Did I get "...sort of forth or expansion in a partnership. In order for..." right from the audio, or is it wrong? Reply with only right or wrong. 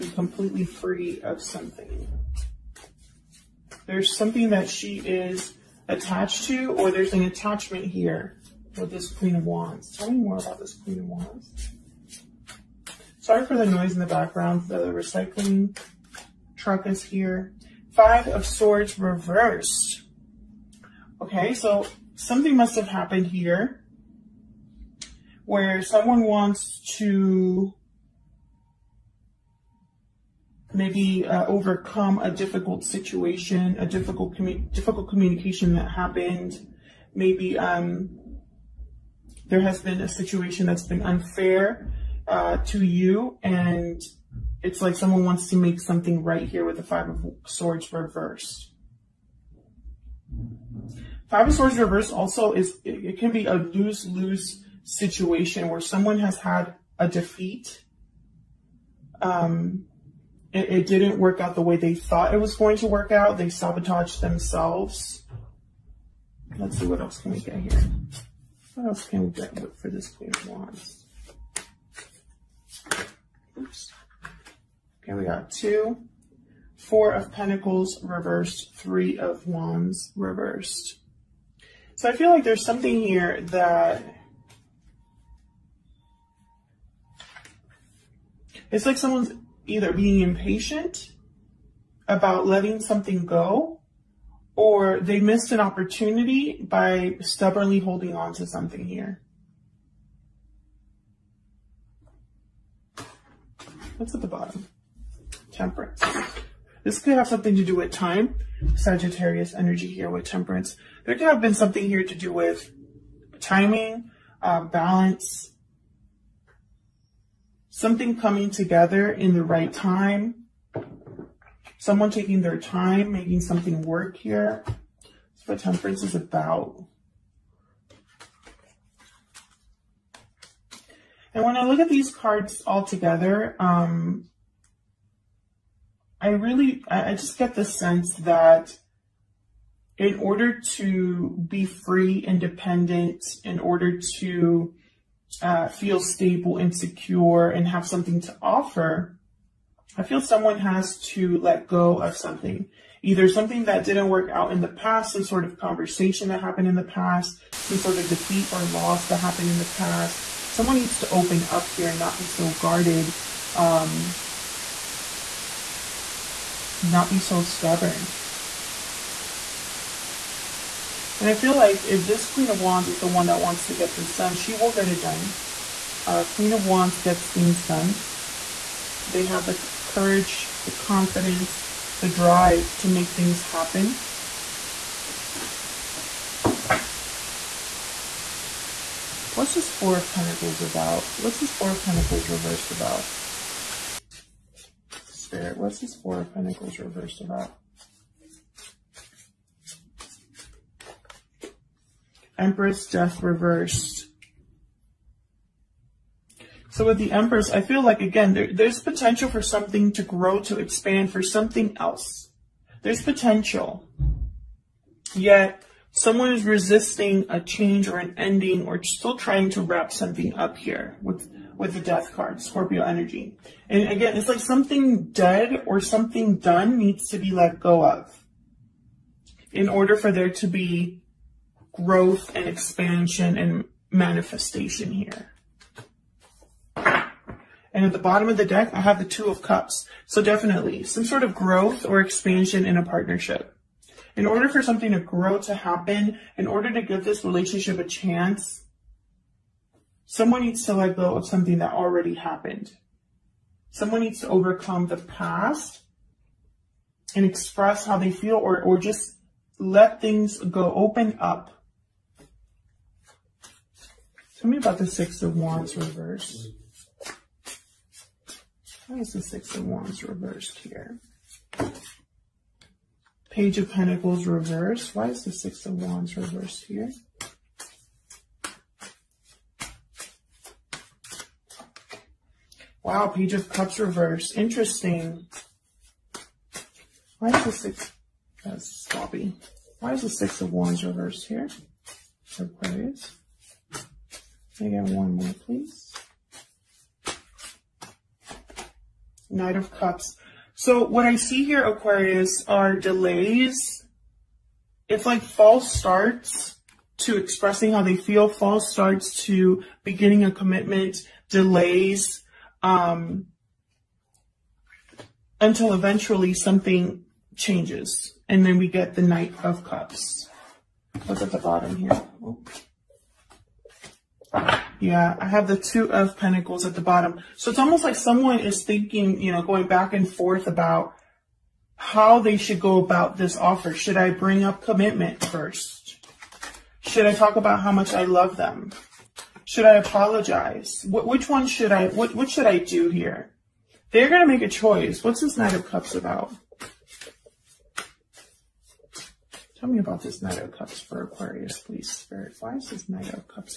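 wrong.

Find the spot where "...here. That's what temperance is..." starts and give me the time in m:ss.
2:04.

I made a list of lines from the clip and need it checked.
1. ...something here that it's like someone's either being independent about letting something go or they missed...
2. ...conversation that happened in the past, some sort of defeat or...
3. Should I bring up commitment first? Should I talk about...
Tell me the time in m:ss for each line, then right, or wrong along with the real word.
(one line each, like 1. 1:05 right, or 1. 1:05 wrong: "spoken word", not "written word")
1. 1:22 wrong: "impatient", not "independent"
2. 2:35 right
3. 5:33 right.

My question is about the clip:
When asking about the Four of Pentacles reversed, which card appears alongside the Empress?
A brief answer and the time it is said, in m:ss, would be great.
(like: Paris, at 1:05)
Death reversed, at 3:22.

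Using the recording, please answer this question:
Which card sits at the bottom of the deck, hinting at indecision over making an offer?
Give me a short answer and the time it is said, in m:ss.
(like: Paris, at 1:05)
Two of Pentacles, at 5:25.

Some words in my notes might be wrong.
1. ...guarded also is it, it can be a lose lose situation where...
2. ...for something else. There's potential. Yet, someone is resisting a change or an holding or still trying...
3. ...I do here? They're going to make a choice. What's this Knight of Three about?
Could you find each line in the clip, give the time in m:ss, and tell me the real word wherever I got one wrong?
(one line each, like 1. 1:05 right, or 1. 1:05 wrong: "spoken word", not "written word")
1. 0:51 wrong: "reversed", not "guarded"
2. 3:31 wrong: "ending", not "holding"
3. 5:42 wrong: "Cups", not "Three".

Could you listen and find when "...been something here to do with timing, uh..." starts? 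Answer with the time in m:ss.
1:51.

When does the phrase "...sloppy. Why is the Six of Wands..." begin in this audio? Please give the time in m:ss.
4:48.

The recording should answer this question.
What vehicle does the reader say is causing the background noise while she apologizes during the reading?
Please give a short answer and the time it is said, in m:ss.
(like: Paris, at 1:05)
Recycling truck, at 0:14.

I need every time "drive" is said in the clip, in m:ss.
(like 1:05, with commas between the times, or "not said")
3:02.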